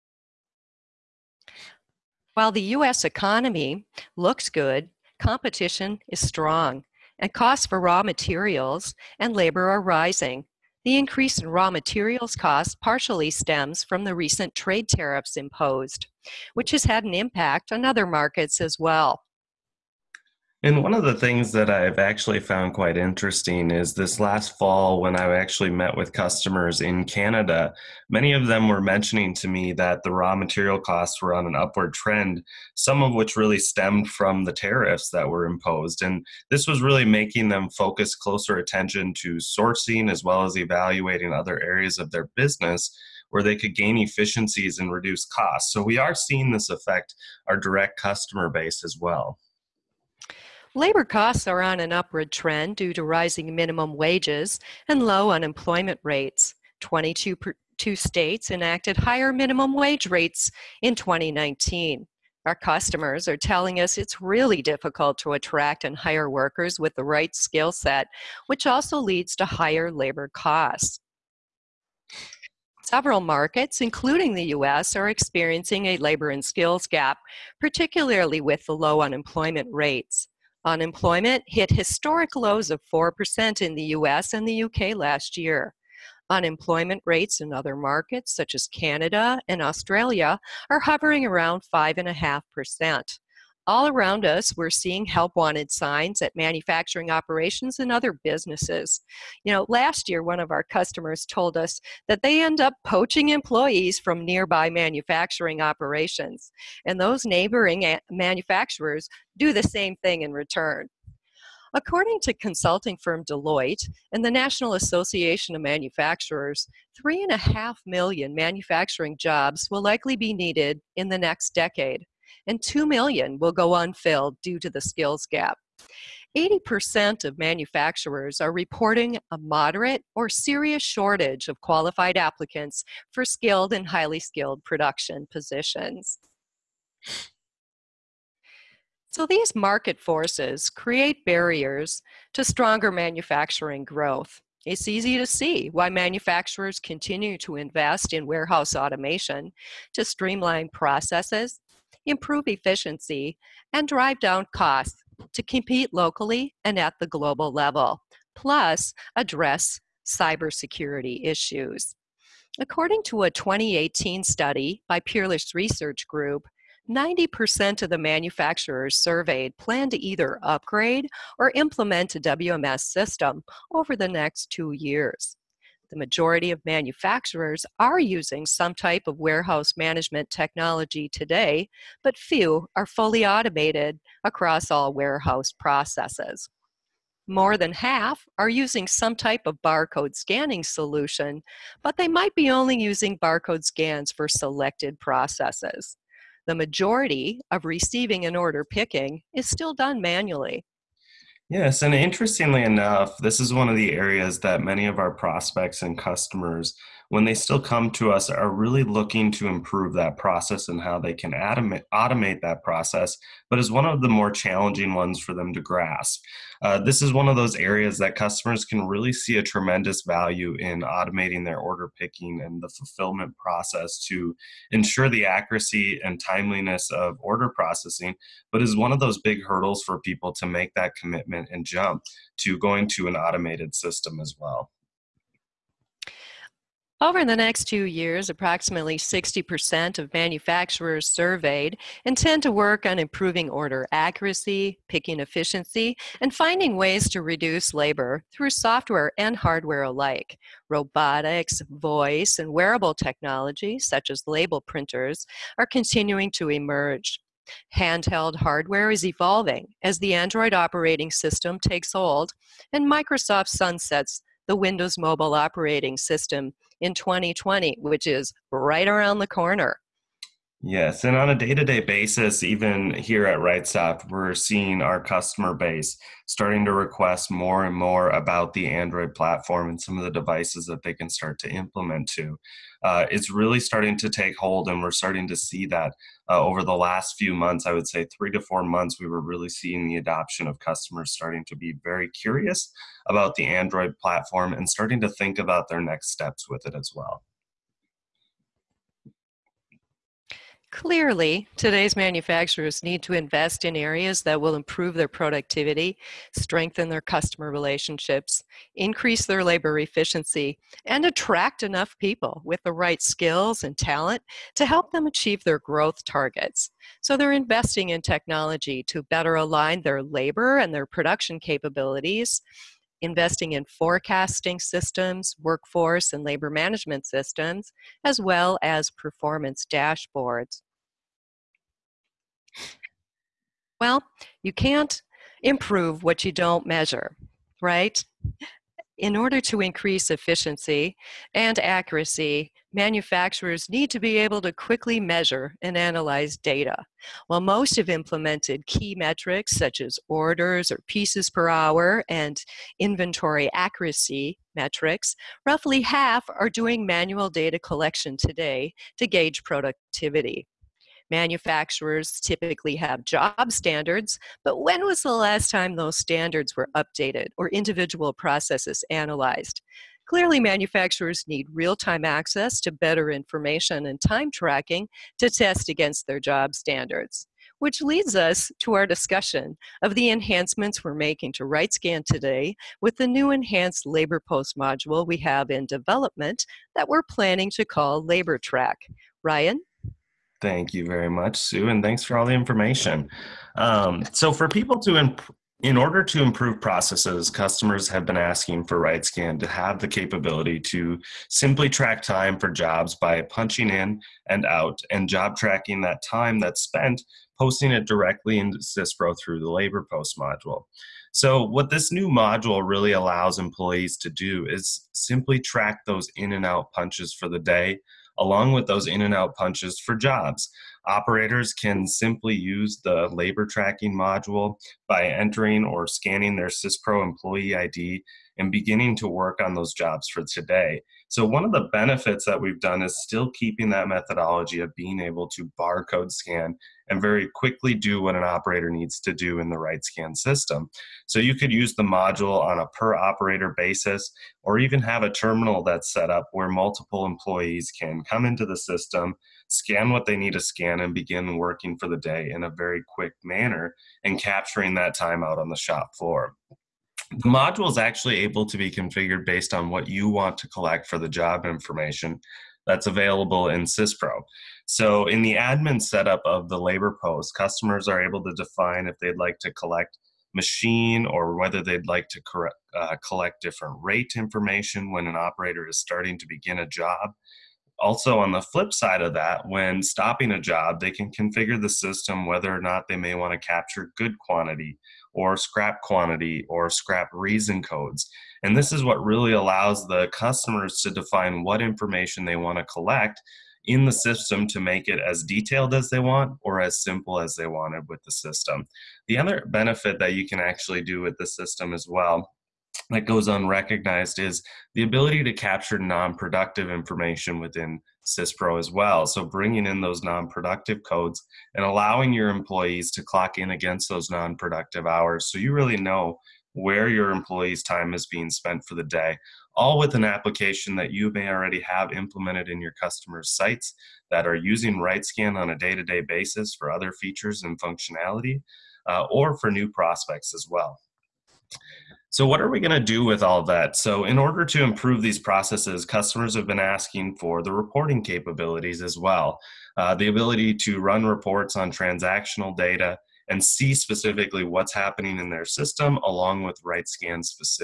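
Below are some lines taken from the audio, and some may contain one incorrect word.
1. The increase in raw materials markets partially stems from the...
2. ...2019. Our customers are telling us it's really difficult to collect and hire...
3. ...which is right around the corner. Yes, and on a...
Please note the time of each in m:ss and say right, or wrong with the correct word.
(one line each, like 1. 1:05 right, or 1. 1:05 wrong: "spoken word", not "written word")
1. 0:10 wrong: "costs", not "markets"
2. 1:00 wrong: "attract", not "collect"
3. 4:27 right.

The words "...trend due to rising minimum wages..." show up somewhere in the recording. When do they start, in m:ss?
0:52.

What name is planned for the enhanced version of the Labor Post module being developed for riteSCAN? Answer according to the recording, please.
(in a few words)
Labor Track.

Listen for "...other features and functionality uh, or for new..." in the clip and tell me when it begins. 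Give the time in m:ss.
8:46.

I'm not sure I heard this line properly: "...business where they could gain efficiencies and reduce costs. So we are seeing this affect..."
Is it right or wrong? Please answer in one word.
right.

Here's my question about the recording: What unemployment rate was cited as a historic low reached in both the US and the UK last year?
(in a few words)
4%.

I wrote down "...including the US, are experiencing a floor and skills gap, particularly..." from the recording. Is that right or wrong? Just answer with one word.
wrong.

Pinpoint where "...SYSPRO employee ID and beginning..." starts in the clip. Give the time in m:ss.
7:06.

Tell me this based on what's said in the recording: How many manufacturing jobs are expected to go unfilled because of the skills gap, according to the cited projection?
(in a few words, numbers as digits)
2 million.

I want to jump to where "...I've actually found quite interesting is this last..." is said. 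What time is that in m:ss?
0:21.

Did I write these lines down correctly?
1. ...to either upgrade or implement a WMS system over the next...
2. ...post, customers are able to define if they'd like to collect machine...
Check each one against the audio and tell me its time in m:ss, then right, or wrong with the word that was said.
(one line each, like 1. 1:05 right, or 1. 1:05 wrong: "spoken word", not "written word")
1. 2:49 right
2. 7:47 right.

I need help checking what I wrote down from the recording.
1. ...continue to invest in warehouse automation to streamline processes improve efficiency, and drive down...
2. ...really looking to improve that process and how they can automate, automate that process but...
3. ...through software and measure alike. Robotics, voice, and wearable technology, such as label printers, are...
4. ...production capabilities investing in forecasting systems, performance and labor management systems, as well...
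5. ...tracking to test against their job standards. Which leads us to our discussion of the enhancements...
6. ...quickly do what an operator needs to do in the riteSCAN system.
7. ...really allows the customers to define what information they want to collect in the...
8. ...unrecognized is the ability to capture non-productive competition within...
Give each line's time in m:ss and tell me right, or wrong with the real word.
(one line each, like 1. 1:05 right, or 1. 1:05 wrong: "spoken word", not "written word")
1. 2:26 right
2. 3:28 right
3. 4:08 wrong: "hardware", not "measure"
4. 5:20 wrong: "workforce", not "performance"
5. 6:14 right
6. 7:17 right
7. 8:09 right
8. 8:23 wrong: "information", not "competition".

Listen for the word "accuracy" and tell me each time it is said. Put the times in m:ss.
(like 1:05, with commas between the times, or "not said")
3:45, 4:03, 5:41, 5:53.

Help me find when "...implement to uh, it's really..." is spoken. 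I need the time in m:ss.
4:41.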